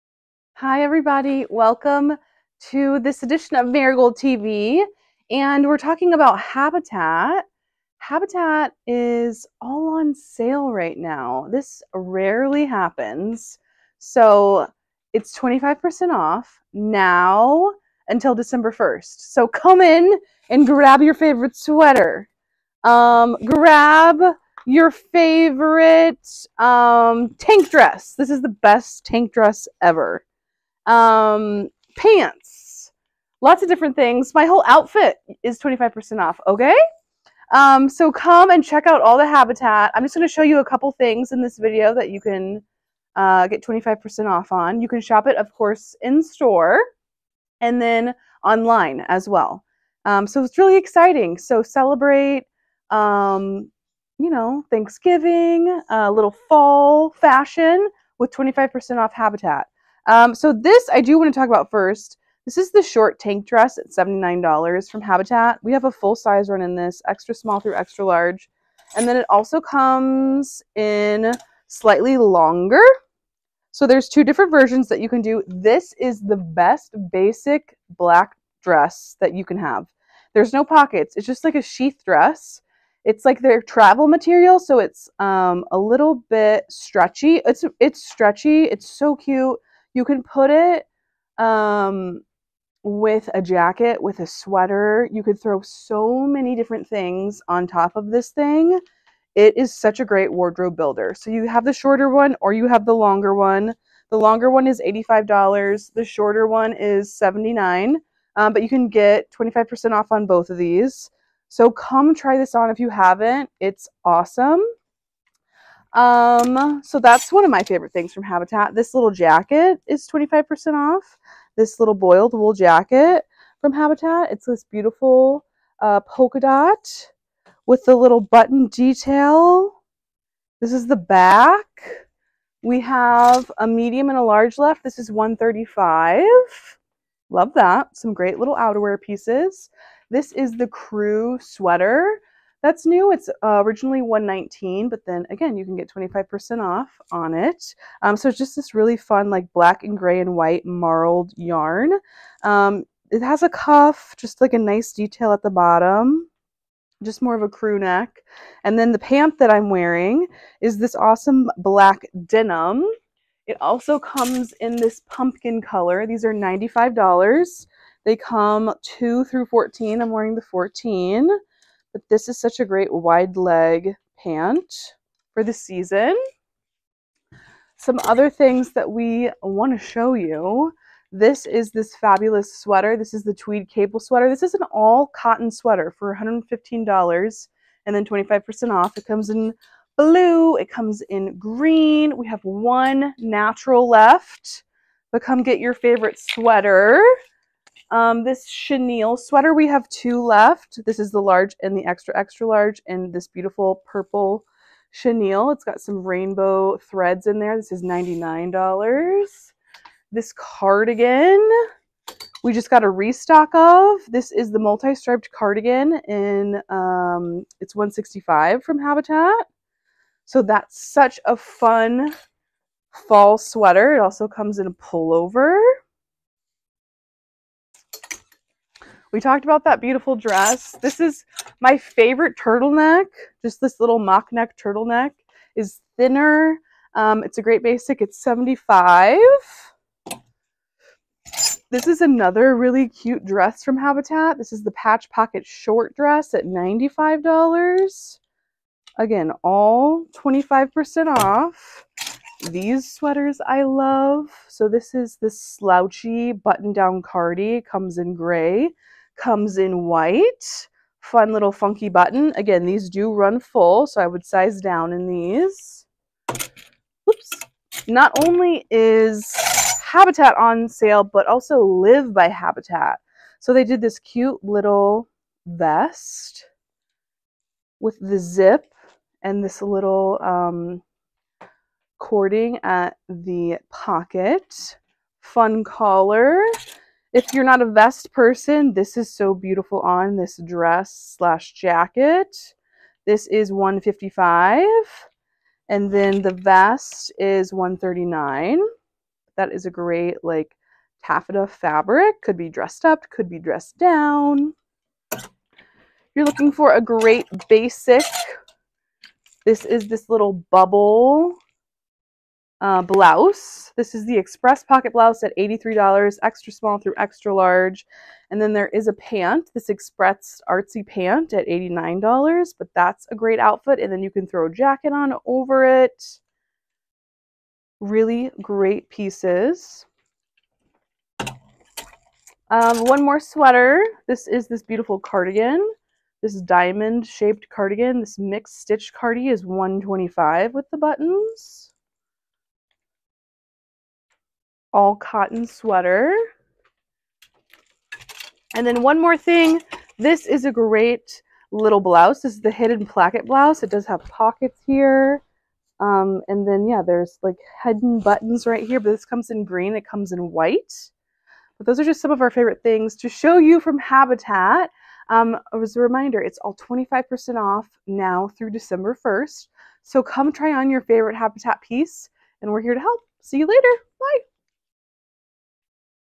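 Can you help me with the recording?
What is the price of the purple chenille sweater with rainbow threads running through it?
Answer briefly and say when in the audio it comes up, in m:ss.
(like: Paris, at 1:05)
$99, at 3:27.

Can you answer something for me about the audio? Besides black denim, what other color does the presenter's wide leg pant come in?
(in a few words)
Pumpkin.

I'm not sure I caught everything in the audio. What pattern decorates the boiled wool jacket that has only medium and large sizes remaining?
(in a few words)
Polka dot.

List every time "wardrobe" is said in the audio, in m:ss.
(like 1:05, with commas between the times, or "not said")
1:40.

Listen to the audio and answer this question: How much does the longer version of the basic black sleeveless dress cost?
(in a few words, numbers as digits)
$85.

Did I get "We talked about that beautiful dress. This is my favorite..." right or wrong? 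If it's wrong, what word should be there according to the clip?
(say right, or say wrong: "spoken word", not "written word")
right.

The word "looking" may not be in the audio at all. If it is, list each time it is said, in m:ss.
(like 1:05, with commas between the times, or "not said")
5:06.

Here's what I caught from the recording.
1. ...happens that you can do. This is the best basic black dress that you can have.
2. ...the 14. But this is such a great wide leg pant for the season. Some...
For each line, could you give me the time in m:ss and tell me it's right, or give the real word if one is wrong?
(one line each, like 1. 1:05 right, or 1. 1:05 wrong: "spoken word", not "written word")
1. 1:14 wrong: "versions", not "happens"
2. 2:50 right.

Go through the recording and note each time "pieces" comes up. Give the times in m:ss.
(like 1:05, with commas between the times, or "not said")
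2:19, 5:28, 6:11.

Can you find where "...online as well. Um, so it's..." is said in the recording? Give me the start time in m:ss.
0:48.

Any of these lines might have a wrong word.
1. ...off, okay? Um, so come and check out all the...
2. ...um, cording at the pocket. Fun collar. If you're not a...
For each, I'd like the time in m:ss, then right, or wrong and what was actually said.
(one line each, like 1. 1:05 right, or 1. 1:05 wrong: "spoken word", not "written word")
1. 0:36 right
2. 4:40 right.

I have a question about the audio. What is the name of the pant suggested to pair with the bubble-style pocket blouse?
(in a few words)
Express artsy pant.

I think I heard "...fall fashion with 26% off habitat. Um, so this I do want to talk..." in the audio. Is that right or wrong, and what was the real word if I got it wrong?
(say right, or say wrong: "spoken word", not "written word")
wrong: "25", not "26".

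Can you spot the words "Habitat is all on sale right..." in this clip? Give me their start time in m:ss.
0:07.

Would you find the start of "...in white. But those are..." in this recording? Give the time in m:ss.
6:00.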